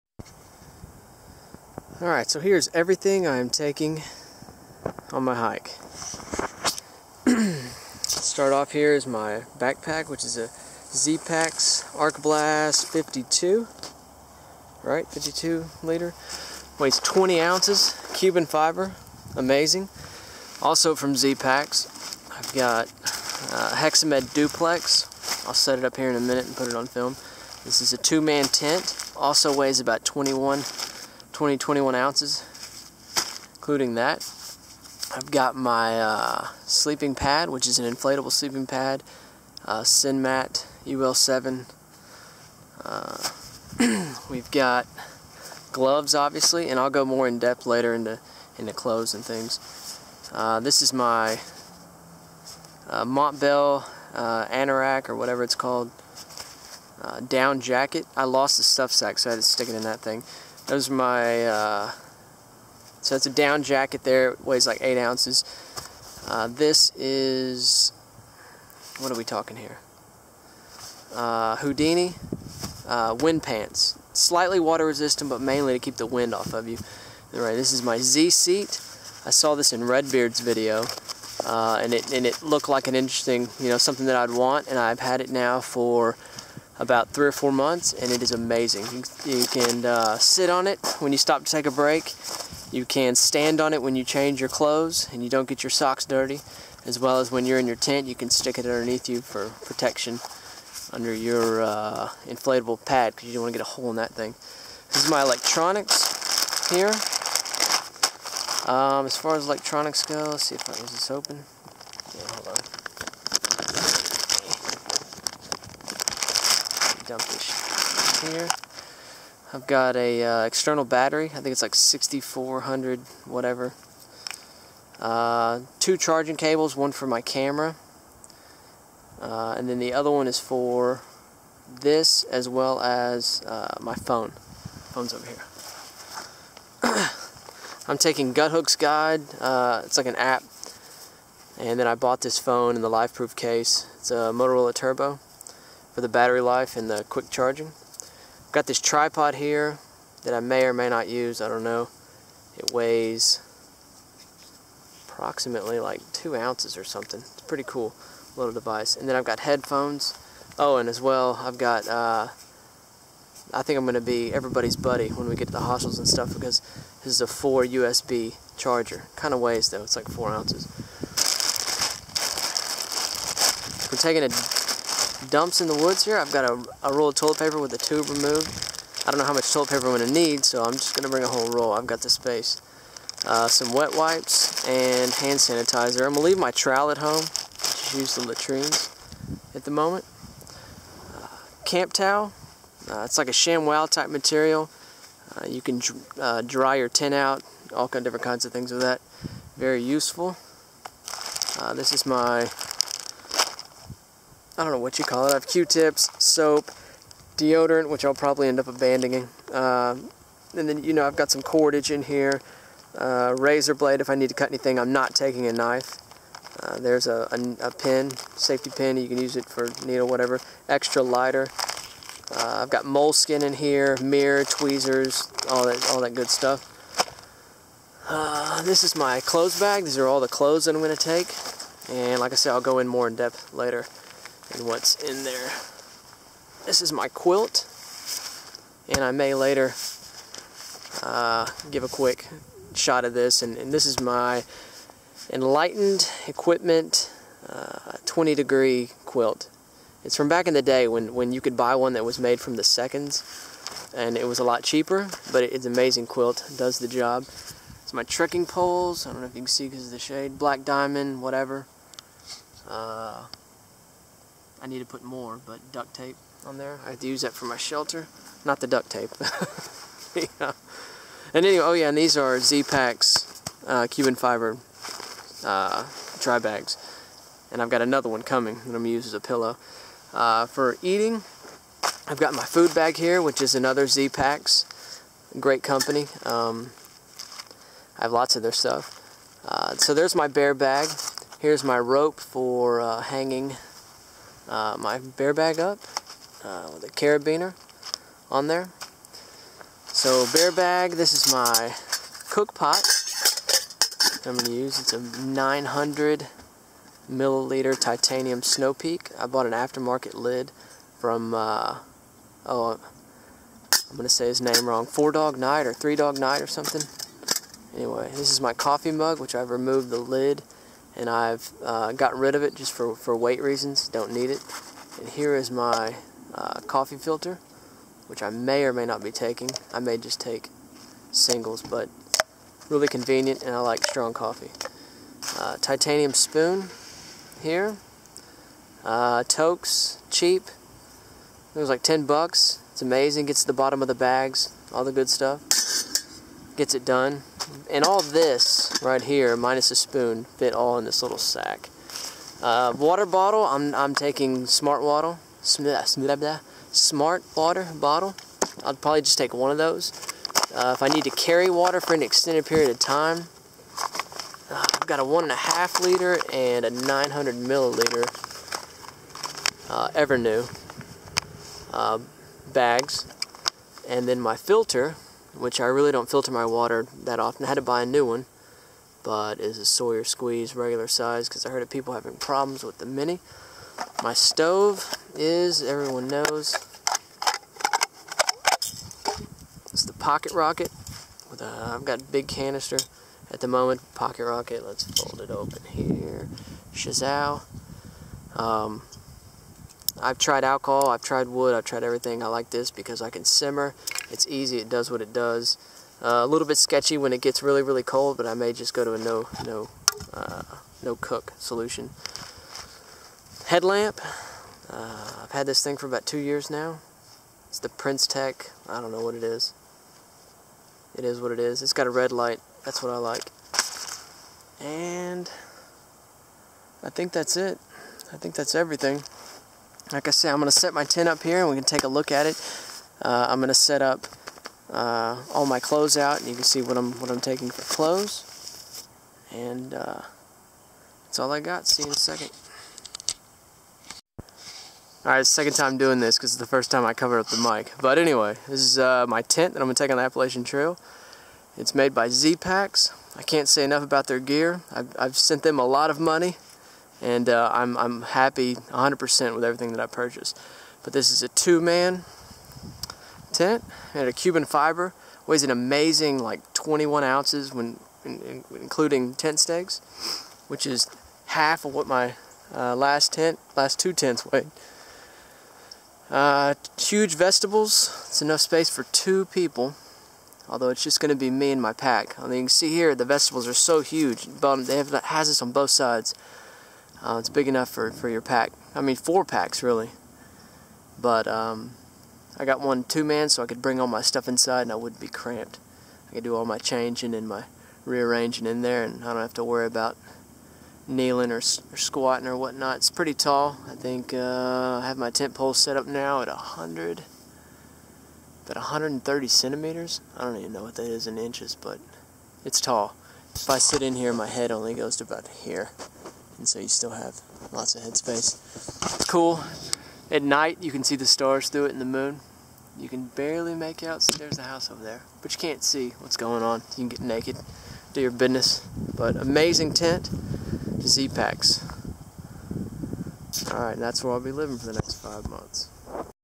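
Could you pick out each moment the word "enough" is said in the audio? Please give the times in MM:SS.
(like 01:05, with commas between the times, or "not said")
07:33, 07:58, 08:07.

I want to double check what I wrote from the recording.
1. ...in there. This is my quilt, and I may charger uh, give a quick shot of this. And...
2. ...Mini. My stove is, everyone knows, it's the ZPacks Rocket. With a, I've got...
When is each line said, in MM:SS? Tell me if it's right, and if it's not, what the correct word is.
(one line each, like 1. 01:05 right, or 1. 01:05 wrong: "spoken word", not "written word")
1. 03:54 wrong: "later", not "charger"
2. 06:22 wrong: "Pocket", not "ZPacks".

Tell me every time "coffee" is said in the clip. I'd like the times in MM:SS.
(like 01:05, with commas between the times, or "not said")
05:18, 05:26, 05:34.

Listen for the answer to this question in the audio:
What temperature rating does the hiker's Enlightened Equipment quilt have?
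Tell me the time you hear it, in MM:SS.
04:08.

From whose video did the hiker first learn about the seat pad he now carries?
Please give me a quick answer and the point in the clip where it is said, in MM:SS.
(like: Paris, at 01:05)
Redbeard, at 01:19.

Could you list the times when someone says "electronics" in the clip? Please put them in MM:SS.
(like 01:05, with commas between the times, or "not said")
01:45, 01:49.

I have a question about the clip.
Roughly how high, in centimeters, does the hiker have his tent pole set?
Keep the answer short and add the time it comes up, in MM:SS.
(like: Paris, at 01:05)
130, at 08:28.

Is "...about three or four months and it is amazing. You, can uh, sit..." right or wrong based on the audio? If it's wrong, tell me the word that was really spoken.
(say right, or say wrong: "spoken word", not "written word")
right.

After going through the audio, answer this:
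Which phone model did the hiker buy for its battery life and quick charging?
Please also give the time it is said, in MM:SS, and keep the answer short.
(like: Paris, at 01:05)
Motorola Turbo, at 02:24.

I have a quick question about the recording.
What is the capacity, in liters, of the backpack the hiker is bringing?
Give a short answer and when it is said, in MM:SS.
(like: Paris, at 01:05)
52, at 00:15.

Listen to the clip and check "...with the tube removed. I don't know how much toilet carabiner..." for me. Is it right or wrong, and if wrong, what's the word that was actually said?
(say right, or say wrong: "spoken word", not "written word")
wrong: "paper", not "carabiner".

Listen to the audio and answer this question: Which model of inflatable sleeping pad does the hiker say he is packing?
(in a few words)
Sinmat UL7.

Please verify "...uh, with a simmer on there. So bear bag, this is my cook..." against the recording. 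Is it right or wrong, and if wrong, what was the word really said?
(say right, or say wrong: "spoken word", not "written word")
wrong: "carabiner", not "simmer".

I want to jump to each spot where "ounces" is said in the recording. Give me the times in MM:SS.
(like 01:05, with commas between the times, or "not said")
00:17, 00:31, 01:04, 02:36, 02:50, 07:47.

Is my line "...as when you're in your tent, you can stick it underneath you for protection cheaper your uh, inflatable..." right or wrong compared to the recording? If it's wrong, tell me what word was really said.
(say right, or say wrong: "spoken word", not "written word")
wrong: "under", not "cheaper".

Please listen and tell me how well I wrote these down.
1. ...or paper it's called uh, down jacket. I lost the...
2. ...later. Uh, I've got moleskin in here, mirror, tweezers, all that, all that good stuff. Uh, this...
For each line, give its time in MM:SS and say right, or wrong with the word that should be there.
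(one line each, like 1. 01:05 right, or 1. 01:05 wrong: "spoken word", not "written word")
1. 00:55 wrong: "whatever", not "paper"
2. 03:41 wrong: "lighter", not "later".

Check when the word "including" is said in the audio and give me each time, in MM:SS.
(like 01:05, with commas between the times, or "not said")
00:33, 07:48.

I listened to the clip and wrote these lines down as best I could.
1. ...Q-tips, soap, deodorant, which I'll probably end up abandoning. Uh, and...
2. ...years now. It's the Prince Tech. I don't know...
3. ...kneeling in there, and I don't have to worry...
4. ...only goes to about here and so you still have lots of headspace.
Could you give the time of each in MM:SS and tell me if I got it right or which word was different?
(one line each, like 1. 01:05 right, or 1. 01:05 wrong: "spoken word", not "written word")
1. 03:25 right
2. 06:56 right
3. 08:17 wrong: "rearranging", not "kneeling"
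4. 08:34 right.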